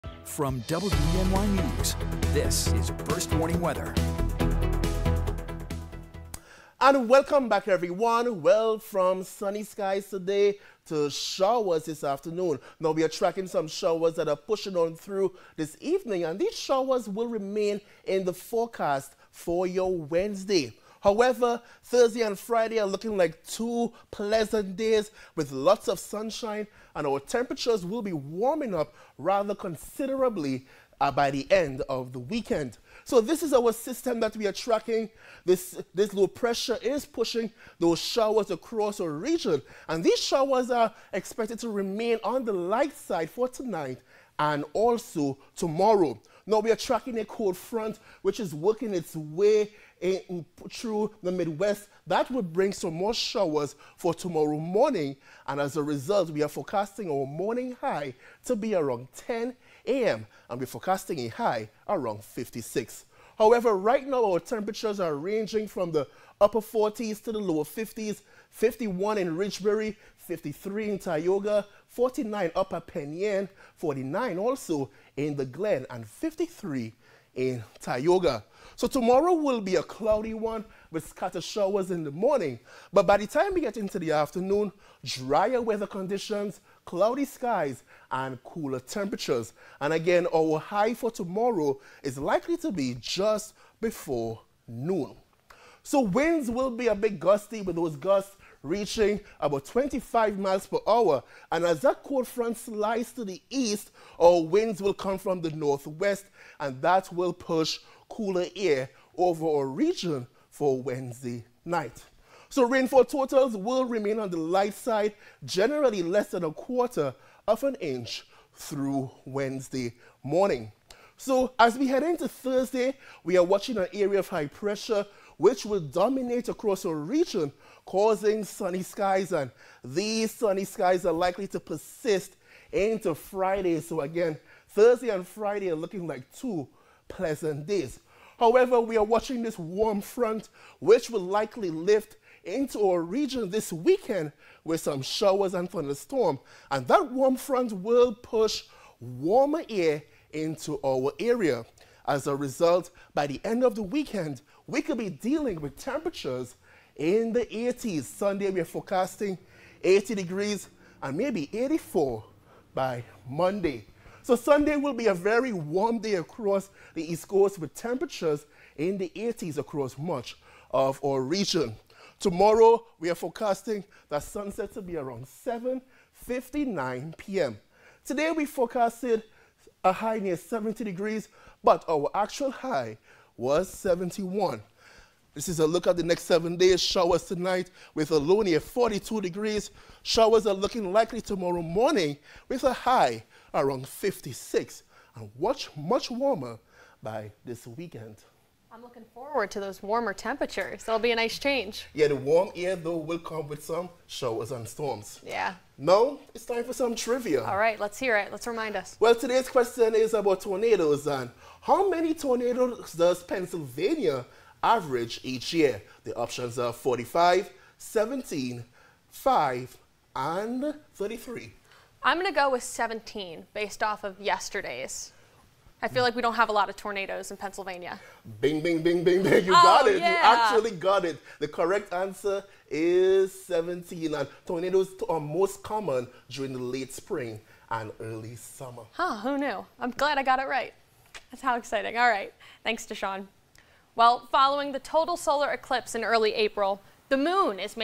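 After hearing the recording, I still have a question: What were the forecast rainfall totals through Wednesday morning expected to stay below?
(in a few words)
a quarter of an inch.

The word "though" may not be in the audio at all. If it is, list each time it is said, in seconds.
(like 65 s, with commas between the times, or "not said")
202 s.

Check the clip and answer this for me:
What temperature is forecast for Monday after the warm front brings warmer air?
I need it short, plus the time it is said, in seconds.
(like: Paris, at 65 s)
84, at 161 s.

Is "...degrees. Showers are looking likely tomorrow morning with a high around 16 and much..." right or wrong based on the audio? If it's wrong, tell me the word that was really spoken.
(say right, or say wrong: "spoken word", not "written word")
wrong: "56", not "16".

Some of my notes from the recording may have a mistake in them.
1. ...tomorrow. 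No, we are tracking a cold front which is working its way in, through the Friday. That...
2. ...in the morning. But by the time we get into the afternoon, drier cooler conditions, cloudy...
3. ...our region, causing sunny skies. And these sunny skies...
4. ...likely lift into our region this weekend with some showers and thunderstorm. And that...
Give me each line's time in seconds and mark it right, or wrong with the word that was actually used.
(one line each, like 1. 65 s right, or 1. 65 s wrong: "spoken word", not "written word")
1. 45 s wrong: "Midwest", not "Friday"
2. 81 s wrong: "weather", not "cooler"
3. 126 s right
4. 141 s right.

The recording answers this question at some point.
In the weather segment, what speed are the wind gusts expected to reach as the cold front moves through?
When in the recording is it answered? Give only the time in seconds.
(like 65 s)
99 s.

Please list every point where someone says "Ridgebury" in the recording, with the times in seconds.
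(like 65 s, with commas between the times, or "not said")
69 s.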